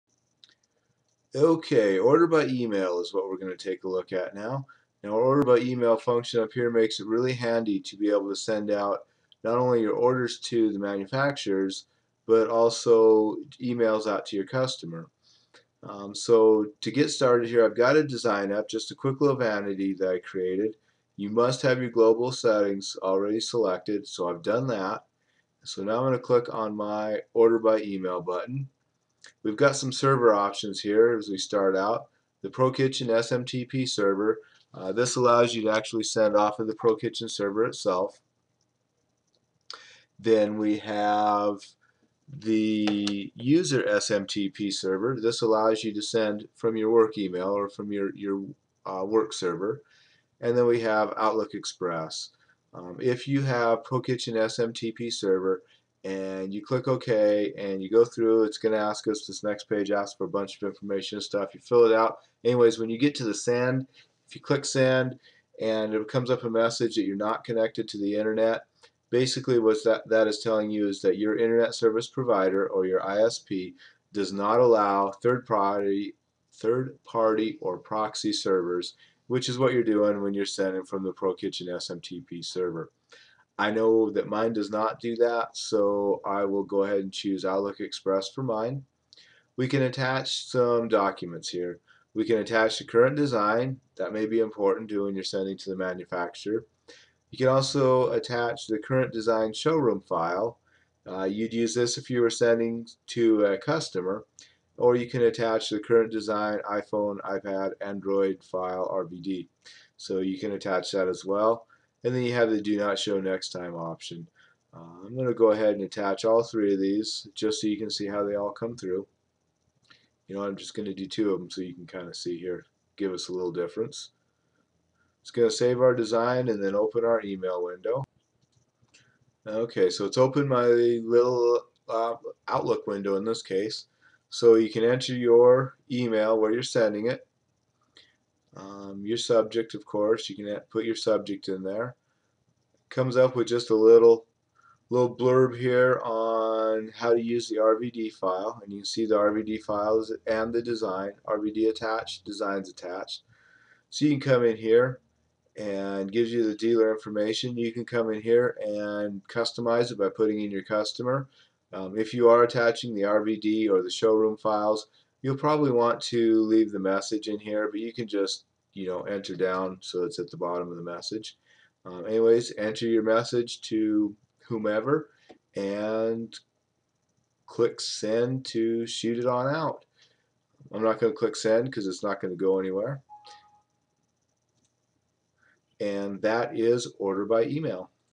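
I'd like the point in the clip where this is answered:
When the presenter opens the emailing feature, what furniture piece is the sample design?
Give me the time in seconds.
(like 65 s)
19 s.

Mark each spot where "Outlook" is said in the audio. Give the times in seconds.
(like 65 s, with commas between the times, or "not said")
51 s, 87 s, 132 s.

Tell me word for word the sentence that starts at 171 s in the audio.
Um, anyways, enter your message to whomever and click send to shoot it on out.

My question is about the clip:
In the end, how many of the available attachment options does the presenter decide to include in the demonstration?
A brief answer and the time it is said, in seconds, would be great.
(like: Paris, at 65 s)
2, at 121 s.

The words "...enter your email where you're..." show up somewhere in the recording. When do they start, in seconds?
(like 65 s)
134 s.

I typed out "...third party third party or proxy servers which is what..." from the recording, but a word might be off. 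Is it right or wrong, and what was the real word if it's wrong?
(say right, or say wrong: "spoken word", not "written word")
right.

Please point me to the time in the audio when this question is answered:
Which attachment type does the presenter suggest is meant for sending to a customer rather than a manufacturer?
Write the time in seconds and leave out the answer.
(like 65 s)
98 s.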